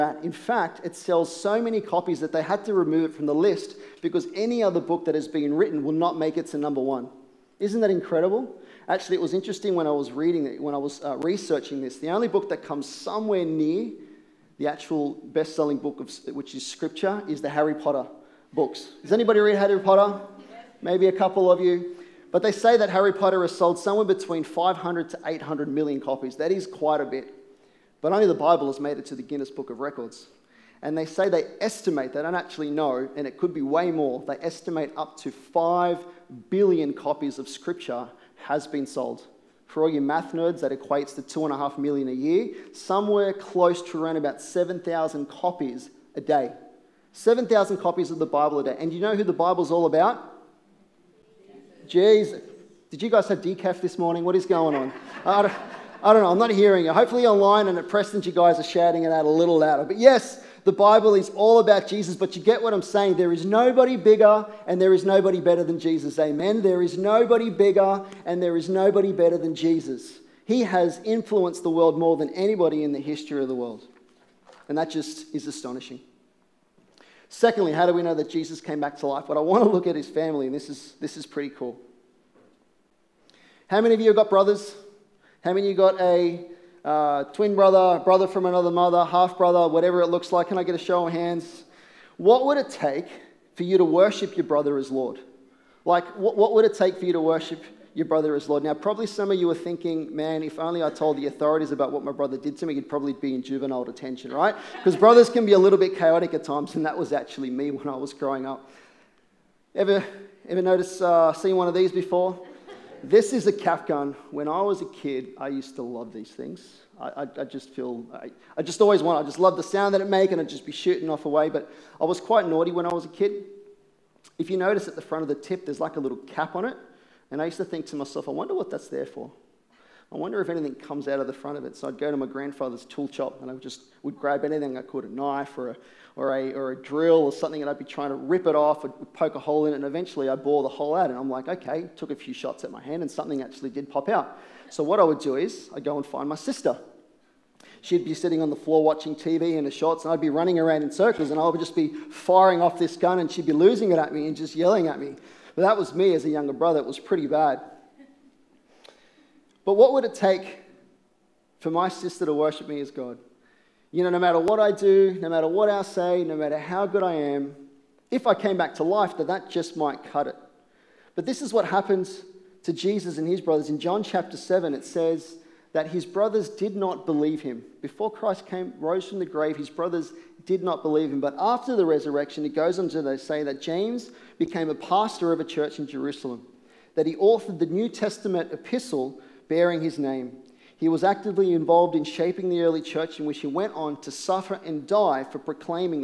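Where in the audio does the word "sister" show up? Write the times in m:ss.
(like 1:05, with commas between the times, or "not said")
2:26, 2:41.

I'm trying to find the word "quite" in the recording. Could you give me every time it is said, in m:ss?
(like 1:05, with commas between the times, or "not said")
0:26, 2:02.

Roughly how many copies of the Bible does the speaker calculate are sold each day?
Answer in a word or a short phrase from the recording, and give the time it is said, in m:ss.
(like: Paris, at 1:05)
7,000, at 0:44.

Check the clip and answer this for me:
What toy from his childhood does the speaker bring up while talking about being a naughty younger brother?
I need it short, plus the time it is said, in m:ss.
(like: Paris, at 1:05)
Cap gun, at 1:53.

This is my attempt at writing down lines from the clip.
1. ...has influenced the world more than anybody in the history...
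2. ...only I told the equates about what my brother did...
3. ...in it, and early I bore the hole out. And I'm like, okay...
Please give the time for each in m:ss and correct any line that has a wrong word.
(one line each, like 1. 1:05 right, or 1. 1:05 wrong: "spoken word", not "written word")
1. 1:10 right
2. 1:40 wrong: "authorities", not "equates"
3. 2:19 wrong: "eventually", not "early".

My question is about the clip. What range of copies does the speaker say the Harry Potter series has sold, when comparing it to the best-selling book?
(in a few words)
500 to 800 million.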